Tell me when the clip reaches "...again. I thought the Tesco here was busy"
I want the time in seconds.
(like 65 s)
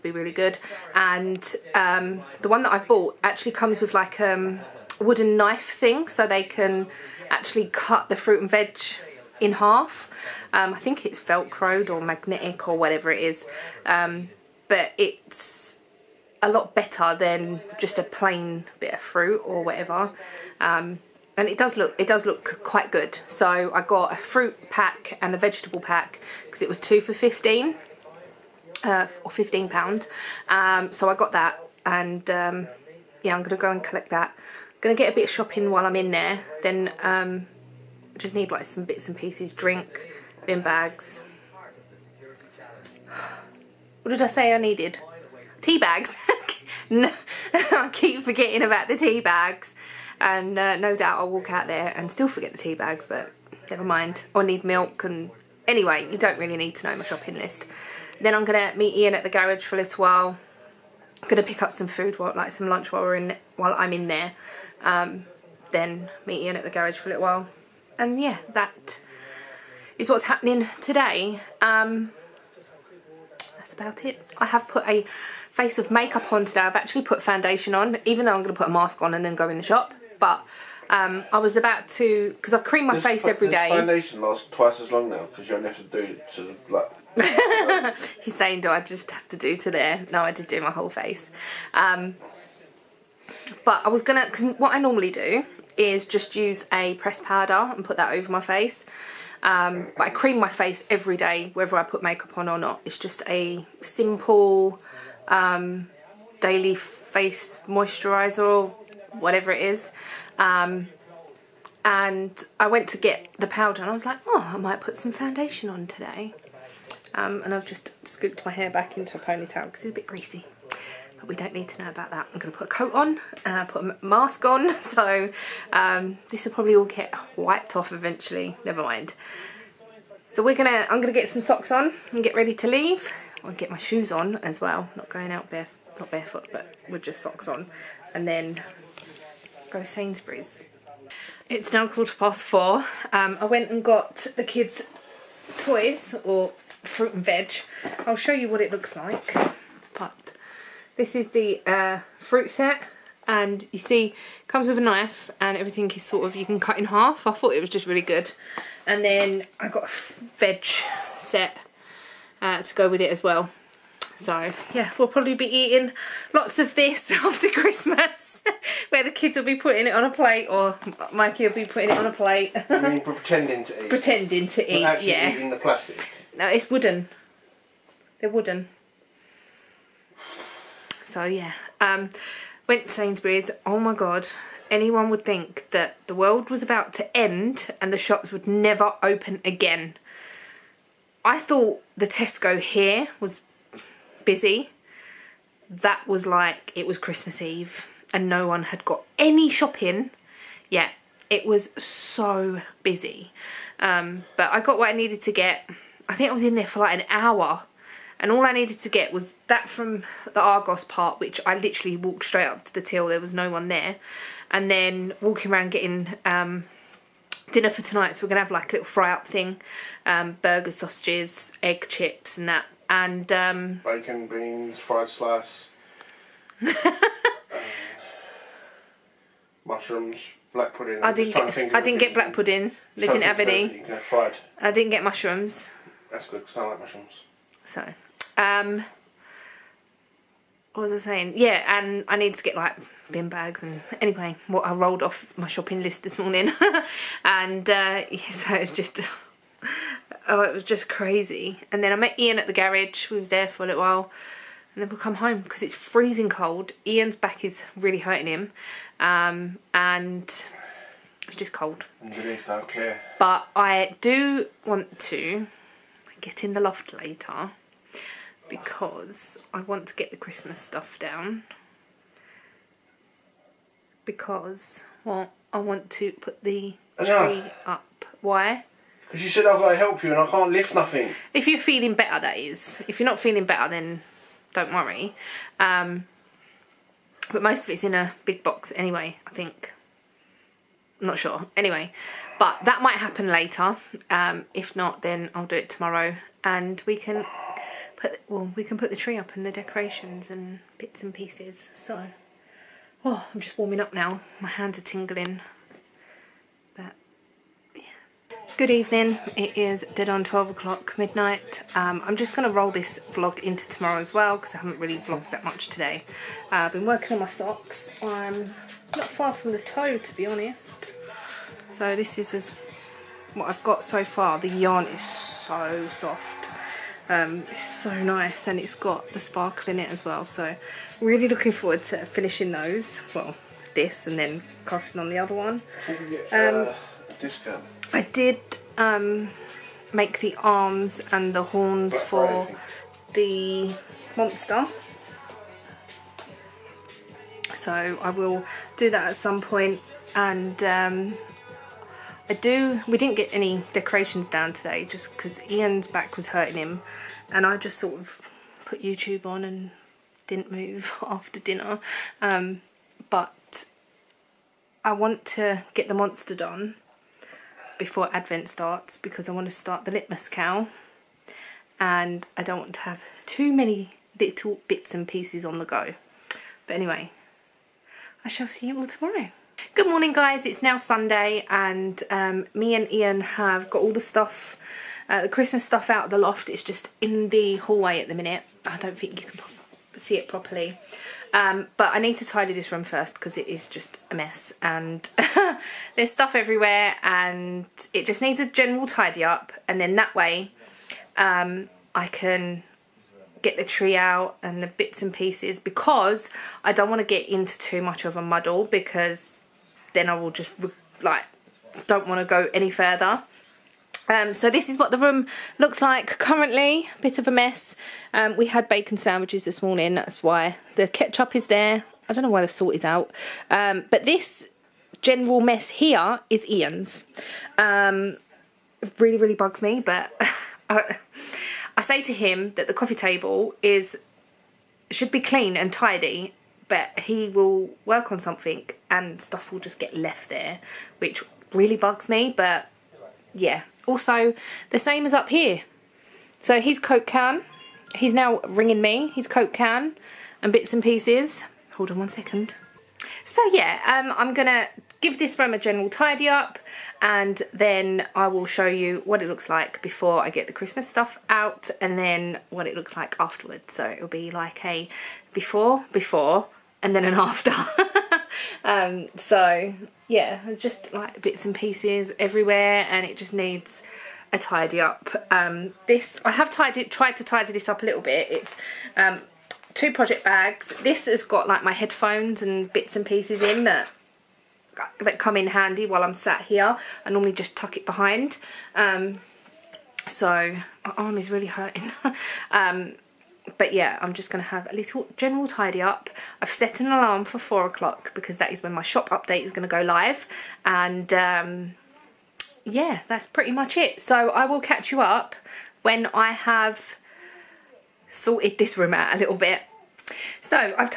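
189 s.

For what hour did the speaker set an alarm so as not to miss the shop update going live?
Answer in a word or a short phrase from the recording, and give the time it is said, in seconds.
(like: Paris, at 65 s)
4 o'clock, at 497 s.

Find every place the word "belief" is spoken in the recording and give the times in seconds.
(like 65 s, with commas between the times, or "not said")
not said.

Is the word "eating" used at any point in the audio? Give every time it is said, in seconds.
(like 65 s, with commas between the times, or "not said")
165 s, 175 s.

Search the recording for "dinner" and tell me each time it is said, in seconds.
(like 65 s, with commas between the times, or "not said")
217 s, 361 s.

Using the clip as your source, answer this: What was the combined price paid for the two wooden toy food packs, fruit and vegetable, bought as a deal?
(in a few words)
£15.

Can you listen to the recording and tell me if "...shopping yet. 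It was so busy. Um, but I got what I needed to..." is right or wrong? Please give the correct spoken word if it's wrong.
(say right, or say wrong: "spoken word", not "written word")
right.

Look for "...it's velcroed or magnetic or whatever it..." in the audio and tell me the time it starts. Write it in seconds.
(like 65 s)
11 s.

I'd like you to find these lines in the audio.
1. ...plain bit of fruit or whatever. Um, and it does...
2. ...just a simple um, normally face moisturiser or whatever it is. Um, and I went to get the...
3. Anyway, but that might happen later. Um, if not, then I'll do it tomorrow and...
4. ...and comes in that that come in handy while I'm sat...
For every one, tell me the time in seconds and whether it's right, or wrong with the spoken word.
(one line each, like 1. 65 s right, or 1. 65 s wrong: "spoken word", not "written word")
1. 18 s right
2. 102 s wrong: "daily", not "normally"
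3. 291 s right
4. 482 s wrong: "pieces", not "comes".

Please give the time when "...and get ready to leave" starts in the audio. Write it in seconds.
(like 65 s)
132 s.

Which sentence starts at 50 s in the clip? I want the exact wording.
And uh, no doubt I'll walk out there and still forget the tea bags, but never mind.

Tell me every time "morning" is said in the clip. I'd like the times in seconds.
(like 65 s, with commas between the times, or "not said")
246 s, 379 s, 419 s.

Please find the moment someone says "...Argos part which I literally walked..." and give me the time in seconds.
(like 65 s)
210 s.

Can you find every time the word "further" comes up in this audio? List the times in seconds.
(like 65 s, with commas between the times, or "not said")
412 s.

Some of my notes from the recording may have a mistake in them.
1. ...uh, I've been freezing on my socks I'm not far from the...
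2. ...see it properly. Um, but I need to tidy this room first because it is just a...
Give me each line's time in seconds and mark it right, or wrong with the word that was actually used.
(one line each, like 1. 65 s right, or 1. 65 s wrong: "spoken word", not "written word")
1. 316 s wrong: "working", not "freezing"
2. 389 s right.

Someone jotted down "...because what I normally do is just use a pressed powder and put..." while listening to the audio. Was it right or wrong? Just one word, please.
right.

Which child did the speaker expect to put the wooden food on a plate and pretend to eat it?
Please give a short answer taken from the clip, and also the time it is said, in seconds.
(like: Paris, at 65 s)
Mikey, at 171 s.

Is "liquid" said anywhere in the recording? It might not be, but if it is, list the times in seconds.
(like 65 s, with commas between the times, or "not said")
not said.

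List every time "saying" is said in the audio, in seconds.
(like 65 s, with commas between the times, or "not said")
88 s, 240 s.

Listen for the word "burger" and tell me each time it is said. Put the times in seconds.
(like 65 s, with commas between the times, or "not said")
220 s.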